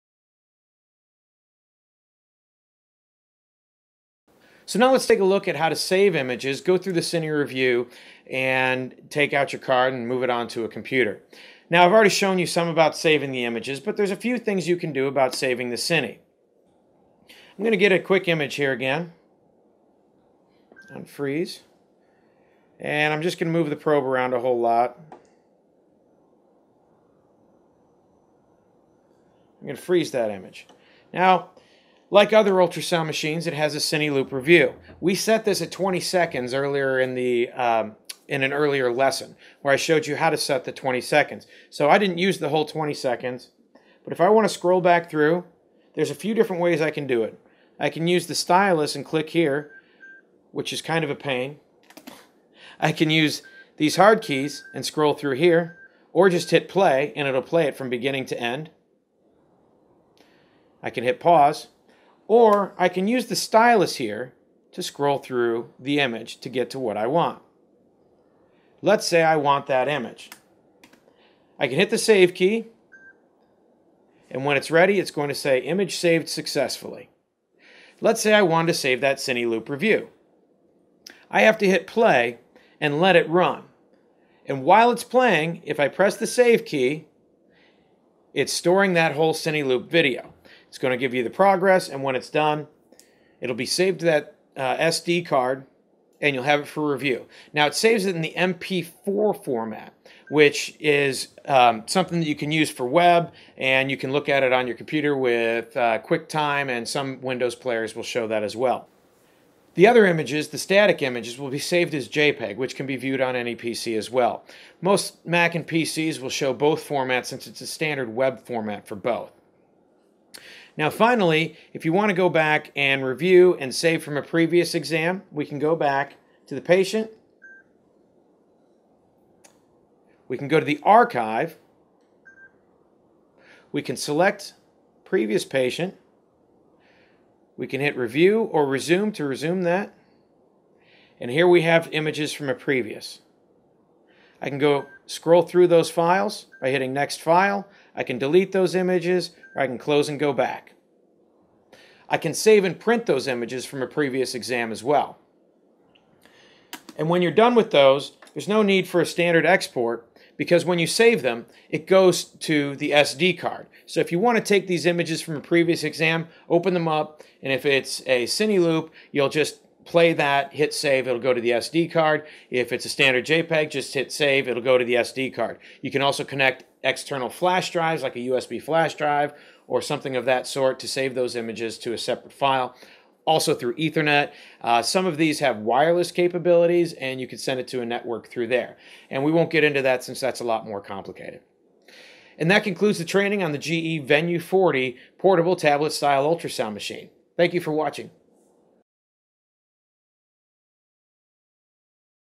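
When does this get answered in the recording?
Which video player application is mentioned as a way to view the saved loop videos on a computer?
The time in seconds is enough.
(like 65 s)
105 s.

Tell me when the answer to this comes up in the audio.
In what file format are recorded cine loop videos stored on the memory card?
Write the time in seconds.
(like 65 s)
98 s.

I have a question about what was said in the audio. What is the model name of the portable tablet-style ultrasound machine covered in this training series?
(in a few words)
GE Venue 40.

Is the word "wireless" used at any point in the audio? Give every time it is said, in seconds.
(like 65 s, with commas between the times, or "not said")
185 s.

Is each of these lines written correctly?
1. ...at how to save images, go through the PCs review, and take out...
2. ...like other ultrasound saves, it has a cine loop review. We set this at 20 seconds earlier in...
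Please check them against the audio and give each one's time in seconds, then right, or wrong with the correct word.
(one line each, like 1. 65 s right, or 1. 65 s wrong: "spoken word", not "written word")
1. 5 s wrong: "Cine", not "PCs"
2. 32 s wrong: "machines", not "saves".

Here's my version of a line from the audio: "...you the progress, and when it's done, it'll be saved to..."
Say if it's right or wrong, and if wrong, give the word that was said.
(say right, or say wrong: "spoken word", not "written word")
right.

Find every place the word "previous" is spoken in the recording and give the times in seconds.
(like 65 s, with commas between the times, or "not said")
124 s, 135 s, 142 s, 153 s, 165 s.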